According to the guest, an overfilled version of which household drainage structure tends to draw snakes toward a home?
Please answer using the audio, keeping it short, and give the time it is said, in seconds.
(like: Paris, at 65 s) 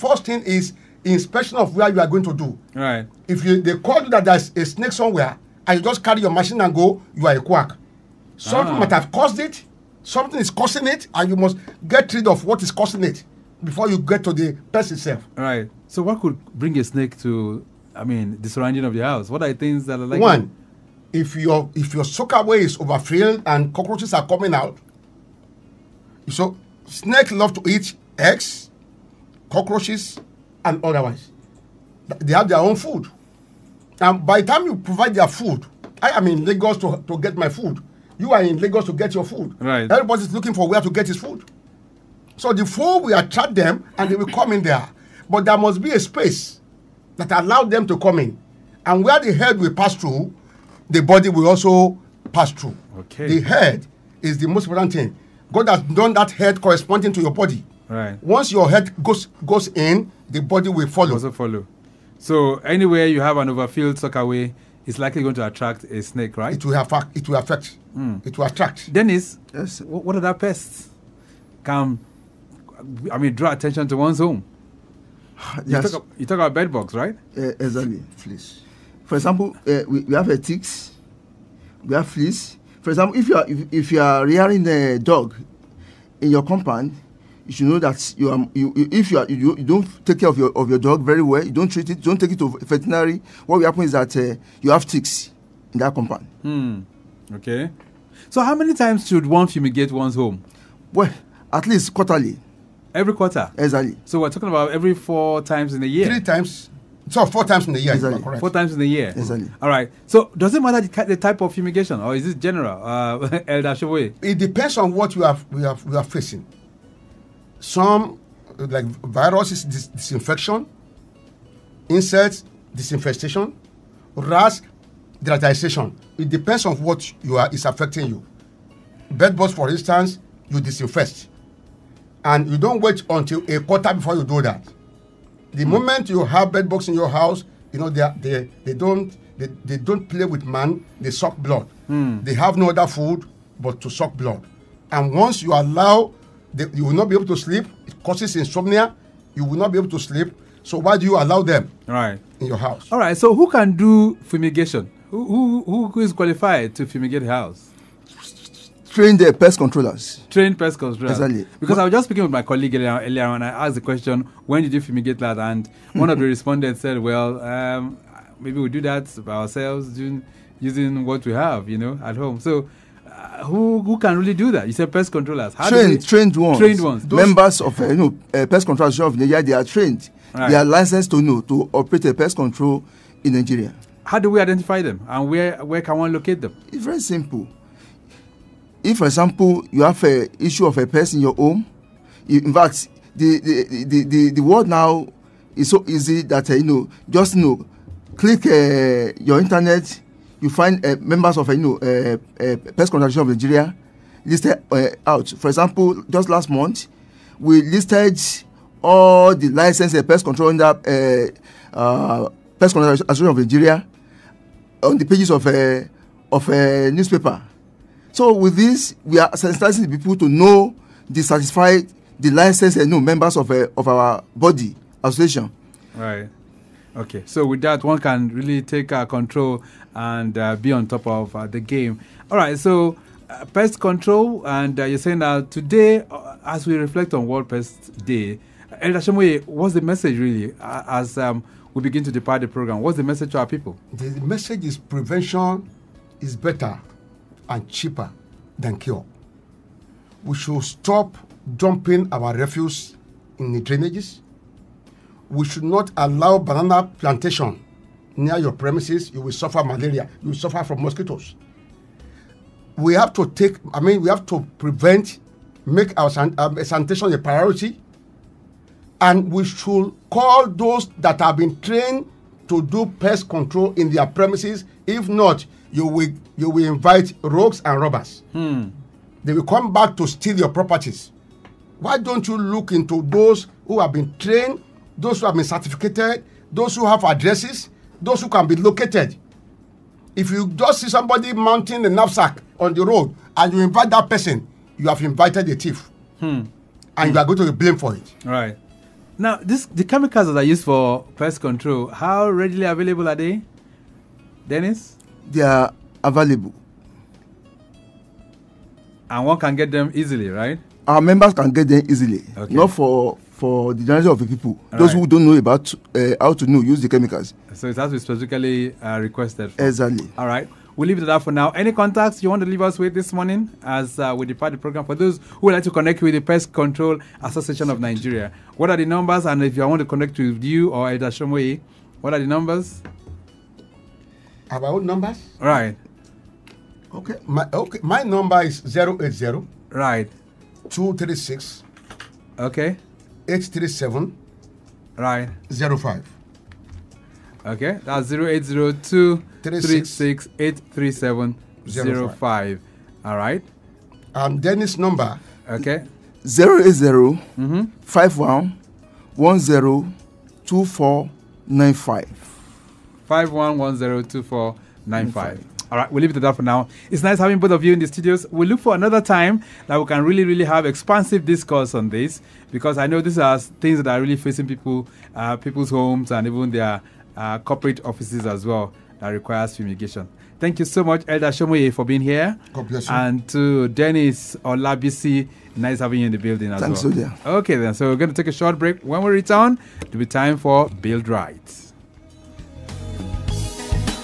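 soakaway, at 22 s.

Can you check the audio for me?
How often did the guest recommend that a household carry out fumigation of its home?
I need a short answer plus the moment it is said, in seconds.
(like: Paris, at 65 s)
quarterly, at 101 s.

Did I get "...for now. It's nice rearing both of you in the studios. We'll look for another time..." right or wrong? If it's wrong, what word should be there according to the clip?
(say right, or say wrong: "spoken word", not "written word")
wrong: "having", not "rearing".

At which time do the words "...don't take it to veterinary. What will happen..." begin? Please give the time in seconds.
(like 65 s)
92 s.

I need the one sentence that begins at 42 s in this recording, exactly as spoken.
So the food will attract them and they will come in there.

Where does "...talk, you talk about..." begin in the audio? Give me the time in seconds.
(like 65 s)
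75 s.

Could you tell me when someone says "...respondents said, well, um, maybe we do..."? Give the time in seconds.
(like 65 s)
166 s.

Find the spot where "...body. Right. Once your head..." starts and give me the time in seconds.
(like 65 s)
57 s.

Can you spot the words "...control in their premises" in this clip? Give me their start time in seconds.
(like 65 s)
273 s.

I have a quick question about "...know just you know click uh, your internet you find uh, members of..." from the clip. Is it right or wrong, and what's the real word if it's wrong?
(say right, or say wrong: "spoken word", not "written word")
right.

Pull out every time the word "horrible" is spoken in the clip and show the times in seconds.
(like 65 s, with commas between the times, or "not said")
not said.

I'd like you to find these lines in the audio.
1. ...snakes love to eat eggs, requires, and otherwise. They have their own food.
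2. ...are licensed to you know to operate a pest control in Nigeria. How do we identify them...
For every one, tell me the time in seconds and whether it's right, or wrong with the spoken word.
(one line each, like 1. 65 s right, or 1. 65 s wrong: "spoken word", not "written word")
1. 26 s wrong: "cockroaches", not "requires"
2. 180 s right.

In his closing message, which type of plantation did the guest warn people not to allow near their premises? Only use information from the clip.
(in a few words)
banana.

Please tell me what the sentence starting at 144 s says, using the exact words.
And once you allow, the, you will not be able to sleep.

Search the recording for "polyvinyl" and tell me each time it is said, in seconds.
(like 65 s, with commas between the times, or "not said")
not said.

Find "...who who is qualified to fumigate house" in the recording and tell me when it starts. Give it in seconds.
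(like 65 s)
155 s.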